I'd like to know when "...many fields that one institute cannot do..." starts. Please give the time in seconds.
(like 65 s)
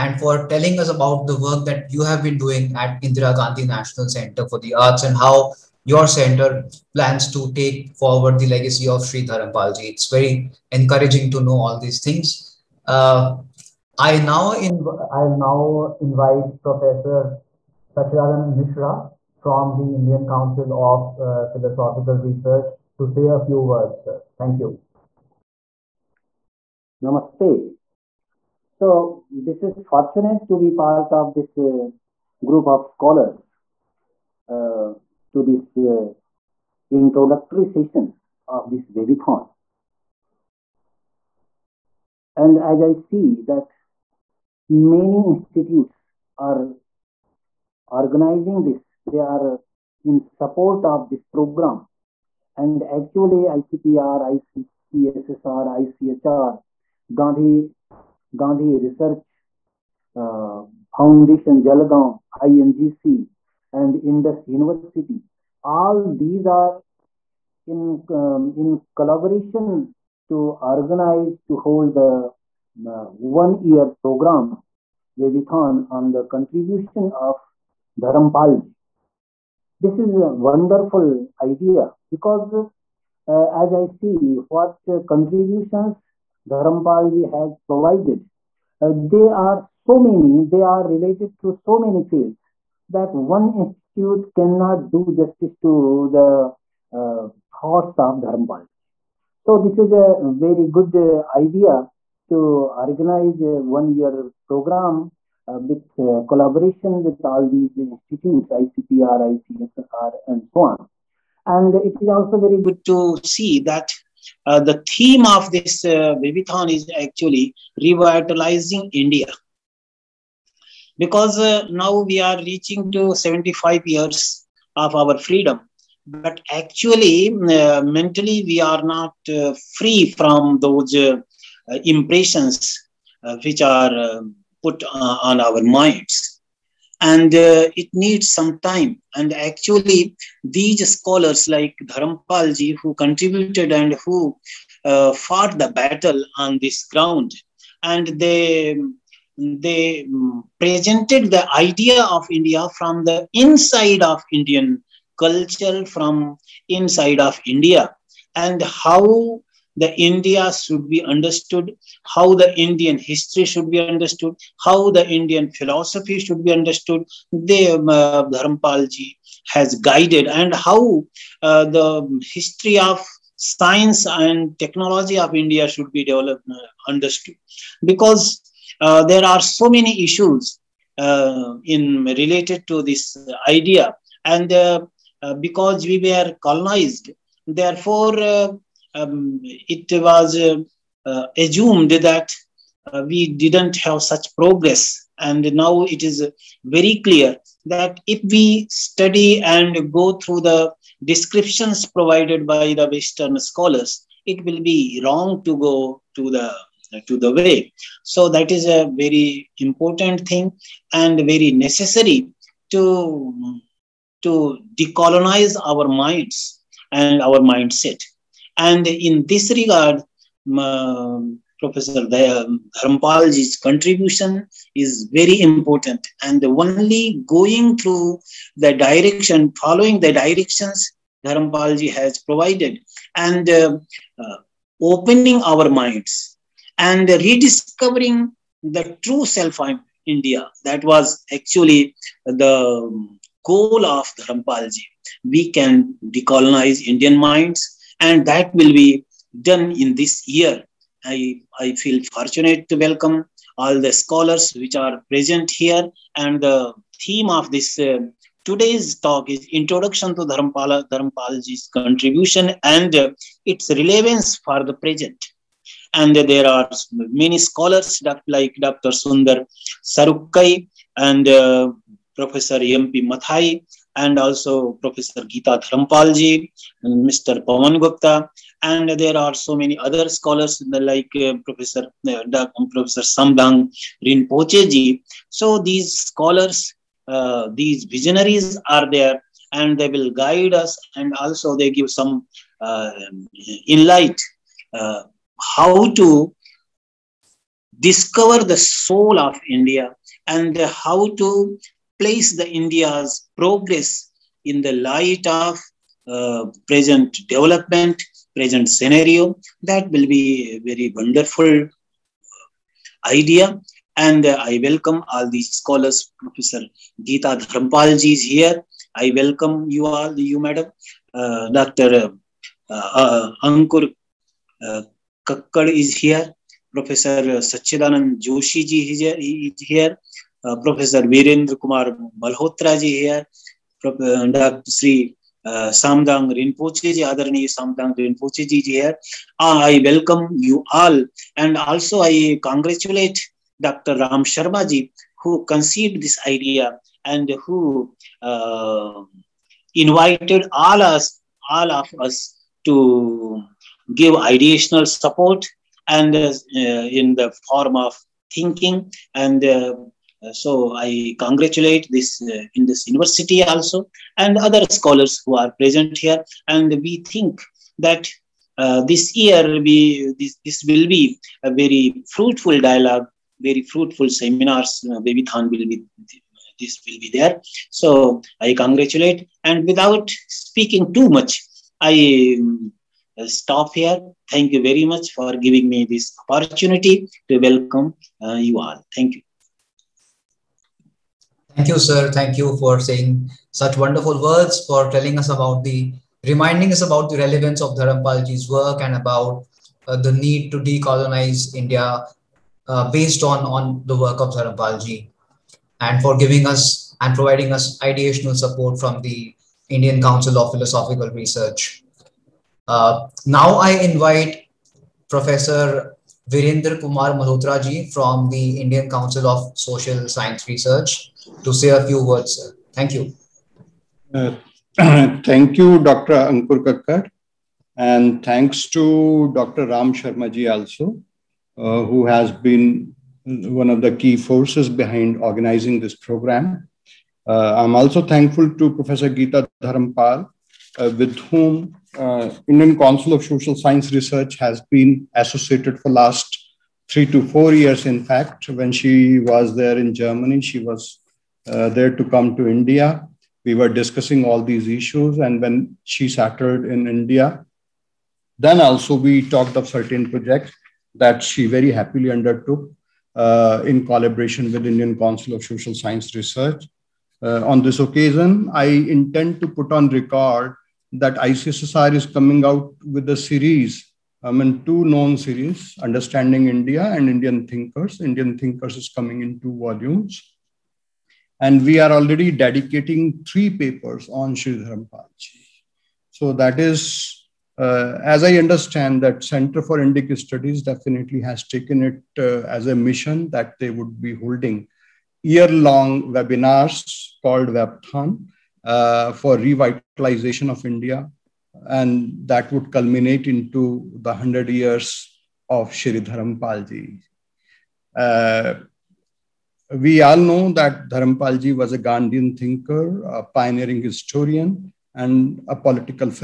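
91 s.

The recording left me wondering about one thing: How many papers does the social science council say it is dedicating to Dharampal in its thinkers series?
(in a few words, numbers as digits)
3.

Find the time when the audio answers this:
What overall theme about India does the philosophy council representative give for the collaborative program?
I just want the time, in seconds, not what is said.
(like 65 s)
117 s.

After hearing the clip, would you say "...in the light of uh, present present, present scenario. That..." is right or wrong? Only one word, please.
wrong.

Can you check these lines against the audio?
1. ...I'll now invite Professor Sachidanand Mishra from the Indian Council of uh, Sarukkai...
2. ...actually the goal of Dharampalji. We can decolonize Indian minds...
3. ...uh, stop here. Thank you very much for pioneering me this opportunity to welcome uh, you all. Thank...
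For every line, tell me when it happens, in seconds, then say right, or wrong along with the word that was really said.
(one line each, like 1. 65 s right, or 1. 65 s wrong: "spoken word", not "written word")
1. 15 s wrong: "Philosophical", not "Sarukkai"
2. 241 s right
3. 383 s wrong: "giving", not "pioneering".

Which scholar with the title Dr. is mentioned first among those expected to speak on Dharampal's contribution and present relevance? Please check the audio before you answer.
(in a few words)
Sundar Sarukkai.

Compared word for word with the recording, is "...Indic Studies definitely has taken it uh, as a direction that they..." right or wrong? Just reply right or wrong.
wrong.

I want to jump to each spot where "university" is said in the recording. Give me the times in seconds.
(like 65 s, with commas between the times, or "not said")
64 s, 362 s.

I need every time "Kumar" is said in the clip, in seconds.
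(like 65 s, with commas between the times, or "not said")
331 s, 416 s.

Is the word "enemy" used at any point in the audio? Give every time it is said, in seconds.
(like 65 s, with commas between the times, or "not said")
not said.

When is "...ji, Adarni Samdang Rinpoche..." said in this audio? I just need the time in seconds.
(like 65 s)
336 s.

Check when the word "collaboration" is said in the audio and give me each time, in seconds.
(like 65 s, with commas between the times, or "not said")
68 s, 106 s, 463 s.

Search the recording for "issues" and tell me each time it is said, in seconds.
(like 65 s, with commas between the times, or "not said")
180 s, 454 s.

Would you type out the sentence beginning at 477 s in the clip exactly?
Indian Thinkers is coming in two volumes.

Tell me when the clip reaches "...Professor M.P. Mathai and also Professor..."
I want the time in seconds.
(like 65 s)
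272 s.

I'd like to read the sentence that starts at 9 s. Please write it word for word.
It's very encouraging to know all these things.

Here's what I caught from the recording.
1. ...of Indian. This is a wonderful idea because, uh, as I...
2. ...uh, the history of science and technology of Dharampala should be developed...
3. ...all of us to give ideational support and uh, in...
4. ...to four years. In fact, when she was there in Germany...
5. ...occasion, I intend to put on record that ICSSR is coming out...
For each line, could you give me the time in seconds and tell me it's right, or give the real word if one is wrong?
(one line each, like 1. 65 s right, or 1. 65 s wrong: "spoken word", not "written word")
1. 77 s wrong: "Dharampalji", not "Indian"
2. 171 s wrong: "India", not "Dharampala"
3. 351 s right
4. 447 s right
5. 467 s right.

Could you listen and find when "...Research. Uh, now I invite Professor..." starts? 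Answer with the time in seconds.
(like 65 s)
411 s.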